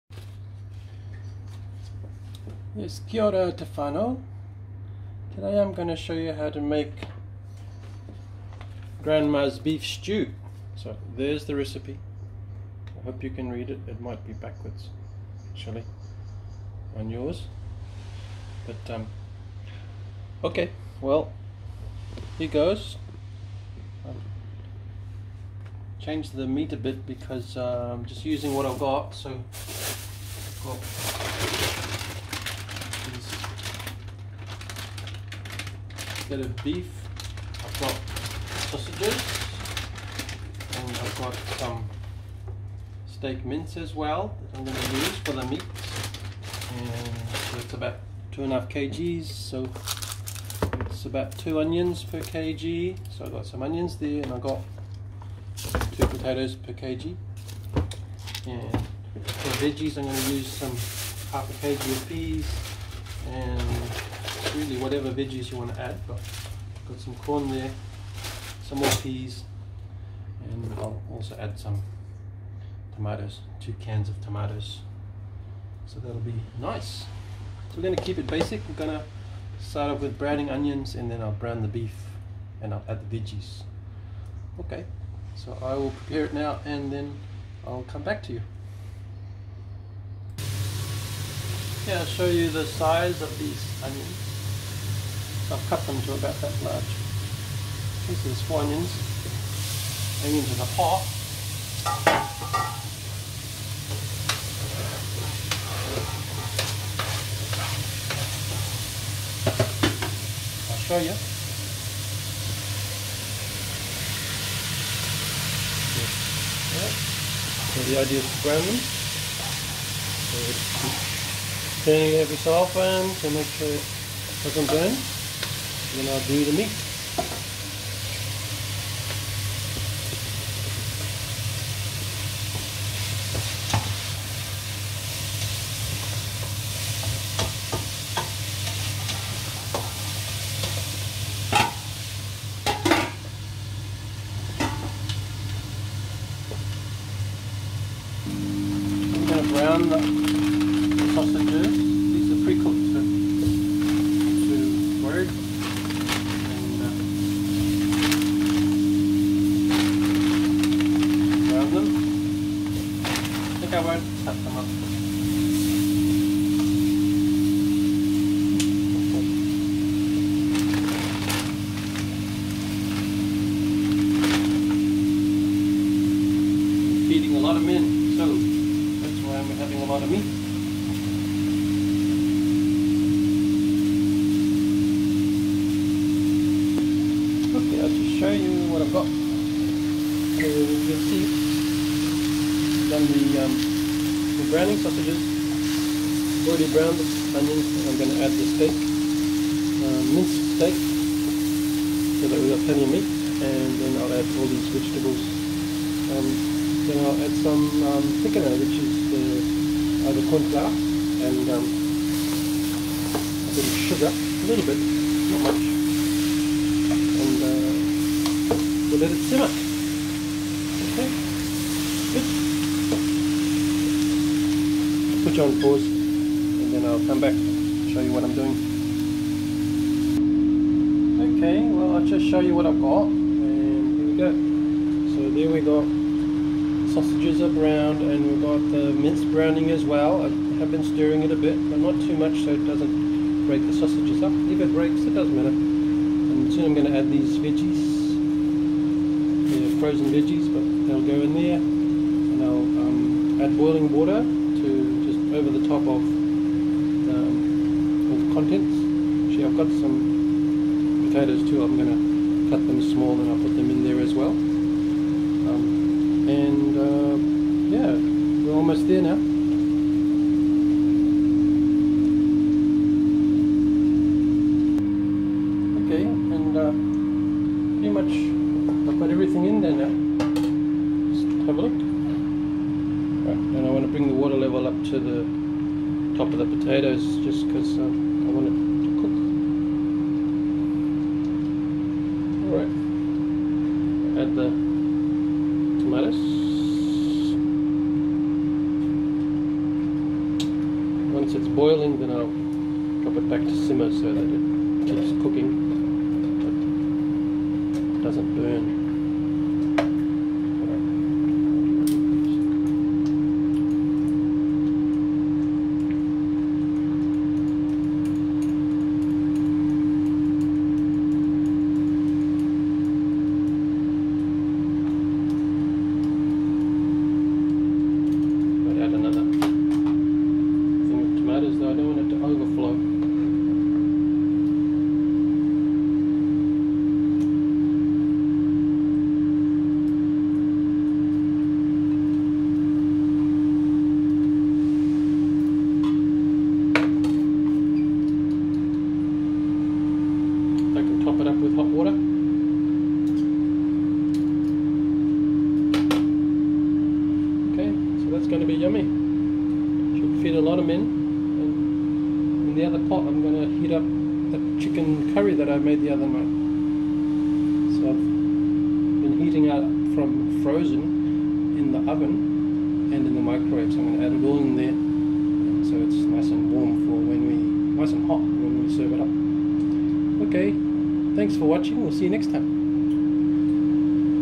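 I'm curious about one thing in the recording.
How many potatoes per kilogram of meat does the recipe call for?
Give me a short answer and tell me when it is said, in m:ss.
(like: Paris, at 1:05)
2, at 0:55.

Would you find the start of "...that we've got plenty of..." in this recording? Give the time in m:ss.
3:22.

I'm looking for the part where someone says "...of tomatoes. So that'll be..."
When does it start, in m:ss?
1:14.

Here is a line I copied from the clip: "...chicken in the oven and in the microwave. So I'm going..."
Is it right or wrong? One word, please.
wrong.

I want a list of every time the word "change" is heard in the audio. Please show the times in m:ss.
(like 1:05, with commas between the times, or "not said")
0:26.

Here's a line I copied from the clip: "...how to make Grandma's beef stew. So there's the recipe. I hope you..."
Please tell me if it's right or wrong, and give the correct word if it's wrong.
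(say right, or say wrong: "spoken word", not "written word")
right.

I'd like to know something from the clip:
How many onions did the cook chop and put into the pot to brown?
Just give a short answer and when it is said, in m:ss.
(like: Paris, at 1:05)
4, at 1:38.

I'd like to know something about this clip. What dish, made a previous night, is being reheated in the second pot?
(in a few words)
chicken curry.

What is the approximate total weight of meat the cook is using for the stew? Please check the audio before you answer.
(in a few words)
2.5 kg.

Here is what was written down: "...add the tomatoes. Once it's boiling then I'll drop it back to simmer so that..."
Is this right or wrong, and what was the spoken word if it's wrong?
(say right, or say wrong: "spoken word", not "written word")
right.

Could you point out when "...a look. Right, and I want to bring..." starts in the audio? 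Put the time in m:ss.
4:41.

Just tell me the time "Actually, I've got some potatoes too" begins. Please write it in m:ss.
4:19.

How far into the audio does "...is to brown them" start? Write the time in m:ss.
1:58.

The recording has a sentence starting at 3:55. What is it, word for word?
So there we got sausages are browned and we've got the mince browning as well.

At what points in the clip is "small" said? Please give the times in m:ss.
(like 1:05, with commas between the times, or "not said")
4:22.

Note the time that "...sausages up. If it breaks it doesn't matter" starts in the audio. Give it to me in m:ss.
4:03.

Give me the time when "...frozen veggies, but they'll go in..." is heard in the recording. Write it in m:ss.
4:09.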